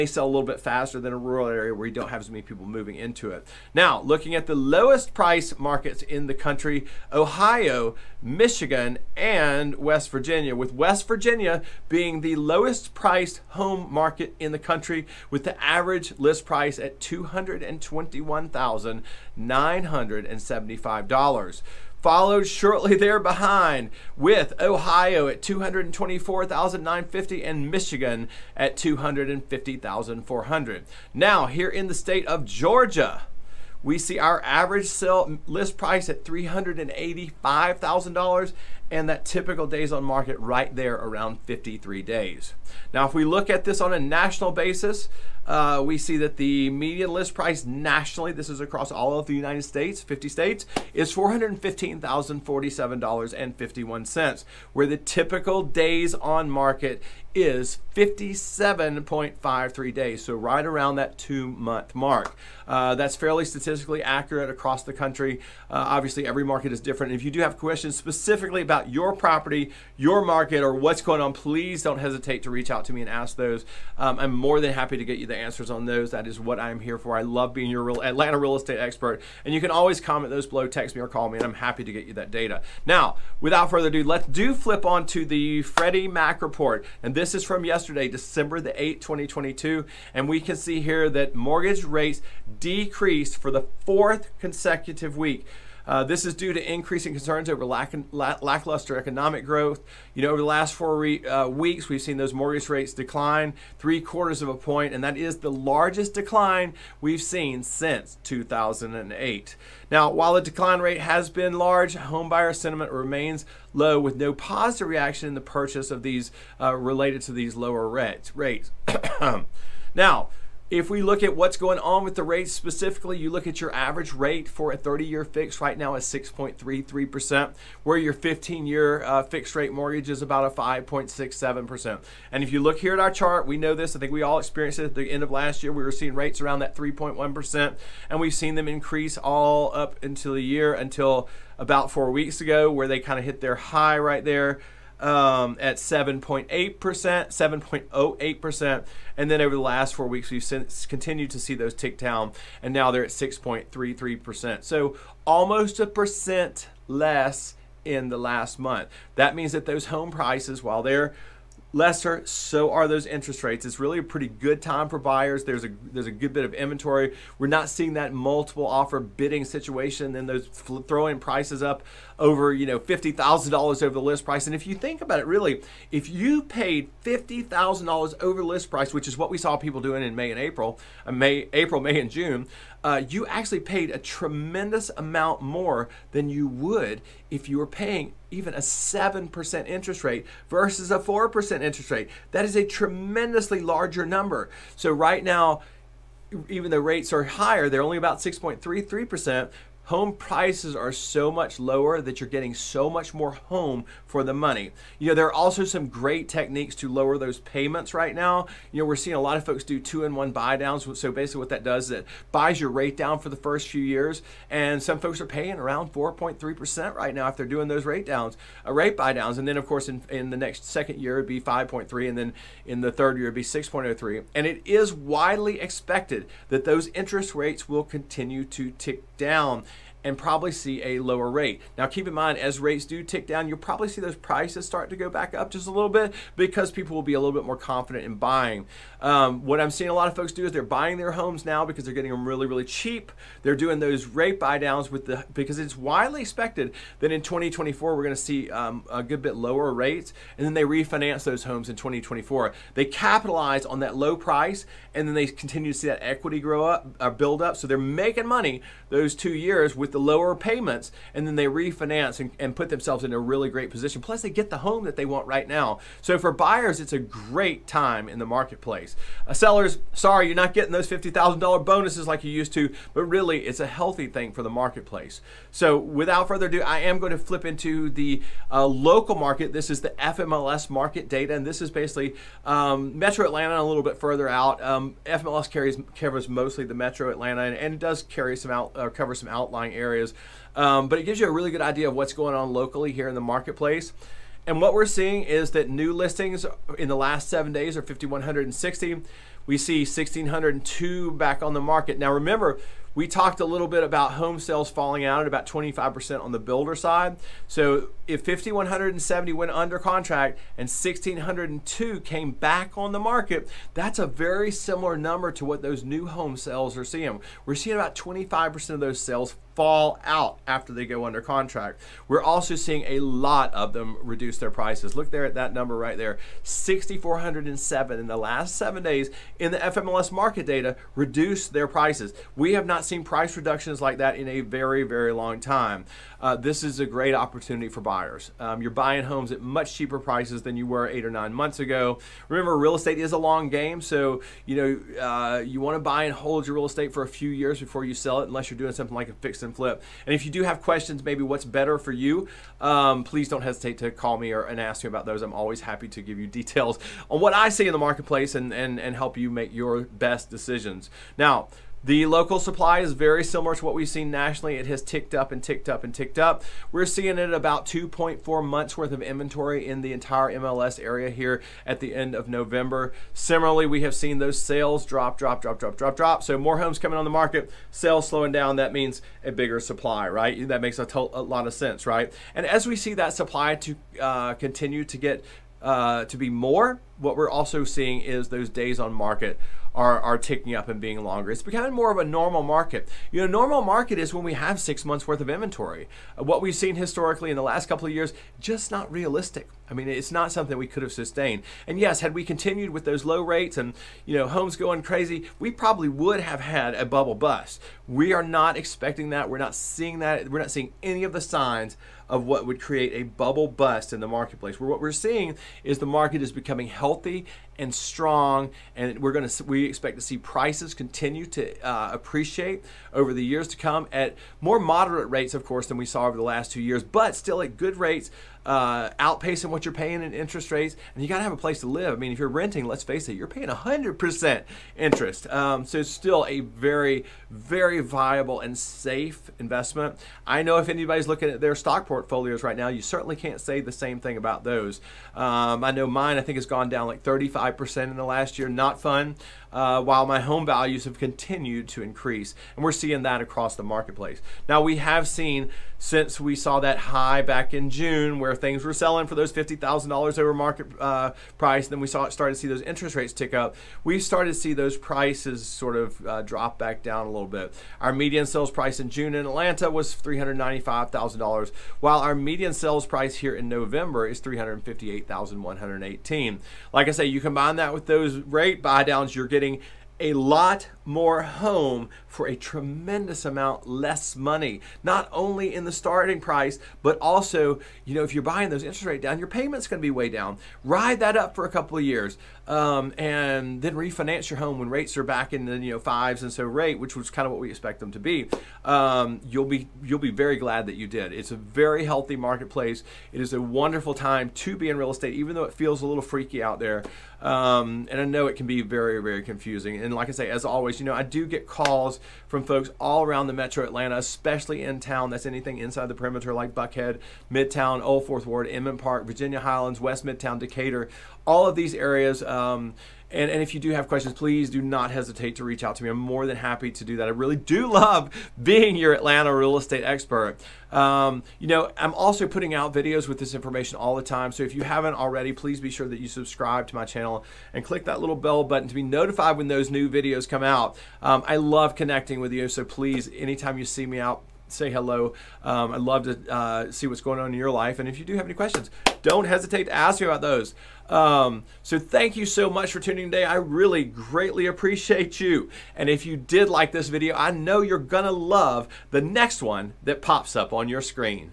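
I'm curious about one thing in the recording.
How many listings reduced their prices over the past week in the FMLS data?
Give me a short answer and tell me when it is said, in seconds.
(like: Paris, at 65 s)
6,407, at 326 s.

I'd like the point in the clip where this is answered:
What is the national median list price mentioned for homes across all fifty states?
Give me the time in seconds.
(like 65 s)
51 s.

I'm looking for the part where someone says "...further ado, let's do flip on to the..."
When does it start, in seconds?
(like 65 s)
83 s.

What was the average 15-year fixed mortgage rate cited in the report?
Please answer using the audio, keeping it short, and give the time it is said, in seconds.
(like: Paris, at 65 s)
5.67%, at 130 s.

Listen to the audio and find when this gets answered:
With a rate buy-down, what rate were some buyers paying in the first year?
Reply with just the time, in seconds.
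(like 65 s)
215 s.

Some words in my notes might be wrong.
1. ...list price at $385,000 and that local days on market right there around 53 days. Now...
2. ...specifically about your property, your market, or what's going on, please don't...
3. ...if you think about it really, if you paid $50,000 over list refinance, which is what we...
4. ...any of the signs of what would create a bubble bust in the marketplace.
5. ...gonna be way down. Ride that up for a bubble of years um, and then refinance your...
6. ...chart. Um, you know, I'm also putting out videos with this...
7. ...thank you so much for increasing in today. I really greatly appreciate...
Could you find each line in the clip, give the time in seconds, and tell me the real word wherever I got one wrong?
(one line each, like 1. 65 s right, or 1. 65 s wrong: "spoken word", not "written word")
1. 35 s wrong: "typical", not "local"
2. 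67 s right
3. 174 s wrong: "price", not "refinance"
4. 410 s right
5. 489 s wrong: "couple", not "bubble"
6. 529 s wrong: "expert", not "chart"
7. 551 s wrong: "tuning", not "increasing".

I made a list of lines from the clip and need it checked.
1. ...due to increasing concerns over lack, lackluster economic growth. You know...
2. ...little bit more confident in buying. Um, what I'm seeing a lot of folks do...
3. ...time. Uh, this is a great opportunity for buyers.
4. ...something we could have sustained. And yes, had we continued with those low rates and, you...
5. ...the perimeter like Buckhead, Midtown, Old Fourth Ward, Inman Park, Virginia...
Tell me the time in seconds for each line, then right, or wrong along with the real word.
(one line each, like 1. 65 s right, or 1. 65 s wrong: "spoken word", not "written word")
1. 96 s right
2. 237 s right
3. 335 s right
4. 400 s right
5. 515 s right.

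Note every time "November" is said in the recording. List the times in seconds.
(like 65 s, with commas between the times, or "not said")
372 s, 473 s.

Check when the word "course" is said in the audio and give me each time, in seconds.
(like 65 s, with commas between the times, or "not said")
219 s, 425 s.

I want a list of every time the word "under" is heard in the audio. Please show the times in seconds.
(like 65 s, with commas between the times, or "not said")
309 s, 321 s.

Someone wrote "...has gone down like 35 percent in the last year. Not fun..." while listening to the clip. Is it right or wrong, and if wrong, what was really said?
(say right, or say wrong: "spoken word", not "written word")
right.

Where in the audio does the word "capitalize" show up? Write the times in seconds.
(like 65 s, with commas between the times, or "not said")
252 s.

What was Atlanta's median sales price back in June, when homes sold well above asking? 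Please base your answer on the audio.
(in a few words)
$395,000.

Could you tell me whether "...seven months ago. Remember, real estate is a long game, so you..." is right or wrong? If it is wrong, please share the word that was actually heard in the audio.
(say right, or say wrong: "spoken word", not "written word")
wrong: "nine", not "seven".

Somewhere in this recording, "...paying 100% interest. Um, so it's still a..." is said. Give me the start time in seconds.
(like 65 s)
433 s.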